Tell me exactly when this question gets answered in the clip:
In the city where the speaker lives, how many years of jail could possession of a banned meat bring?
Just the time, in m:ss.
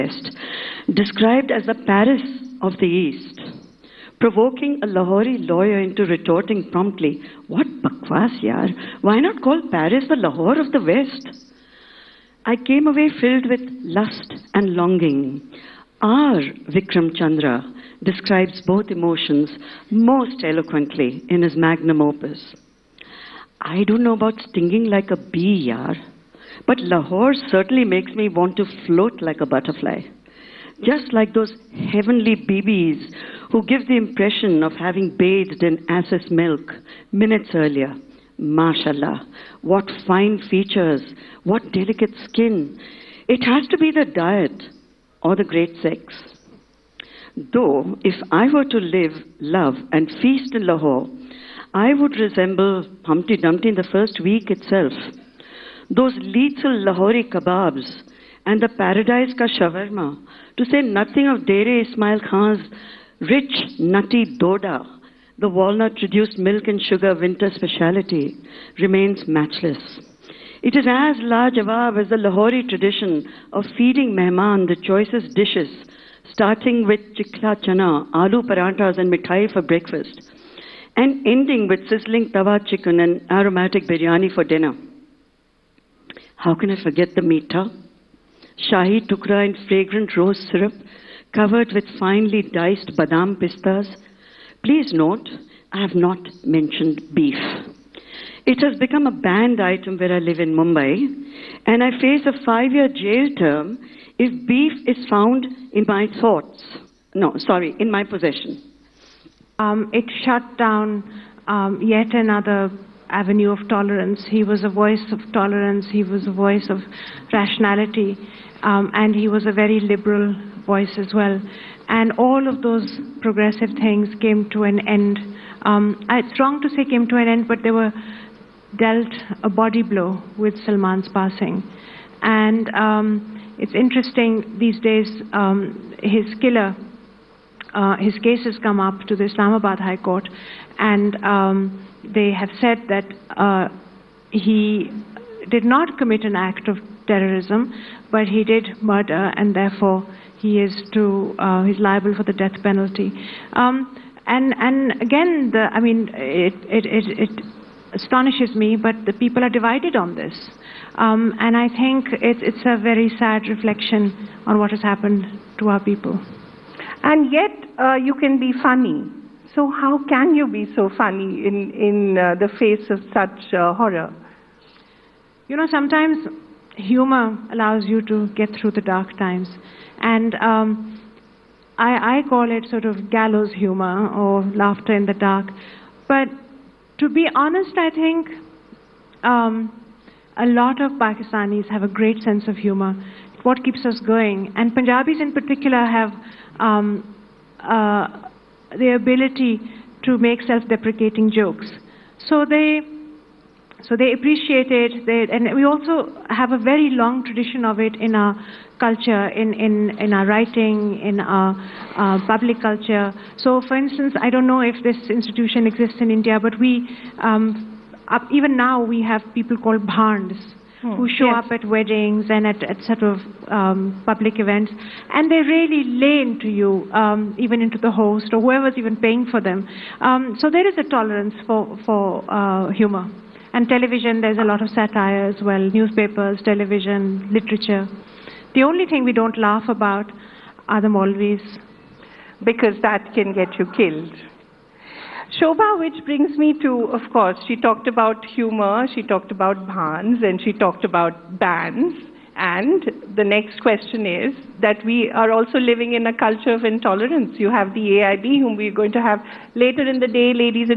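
1:42.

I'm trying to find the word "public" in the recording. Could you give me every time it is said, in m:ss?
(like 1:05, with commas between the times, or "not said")
3:32, 3:44.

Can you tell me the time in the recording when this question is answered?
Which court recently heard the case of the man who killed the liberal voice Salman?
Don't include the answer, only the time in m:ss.
2:19.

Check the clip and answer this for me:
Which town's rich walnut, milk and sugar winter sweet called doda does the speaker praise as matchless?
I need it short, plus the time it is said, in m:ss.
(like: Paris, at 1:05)
Dera Ismail Khan, at 1:01.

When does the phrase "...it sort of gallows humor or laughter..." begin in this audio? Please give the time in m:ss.
3:02.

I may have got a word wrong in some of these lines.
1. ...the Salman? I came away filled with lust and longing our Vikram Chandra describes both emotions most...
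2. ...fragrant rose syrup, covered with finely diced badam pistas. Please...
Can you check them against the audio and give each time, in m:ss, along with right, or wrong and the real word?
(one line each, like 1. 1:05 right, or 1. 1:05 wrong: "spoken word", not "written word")
1. 0:10 wrong: "West", not "Salman"
2. 1:29 right.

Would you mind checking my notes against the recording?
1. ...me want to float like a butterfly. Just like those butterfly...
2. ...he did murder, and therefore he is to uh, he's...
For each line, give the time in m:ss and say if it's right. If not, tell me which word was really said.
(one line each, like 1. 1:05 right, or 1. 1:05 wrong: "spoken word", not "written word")
1. 0:28 wrong: "heavenly", not "butterfly"
2. 2:28 right.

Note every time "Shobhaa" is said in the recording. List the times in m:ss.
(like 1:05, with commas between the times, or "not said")
4:05.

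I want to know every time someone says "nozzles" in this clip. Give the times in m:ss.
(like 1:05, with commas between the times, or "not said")
not said.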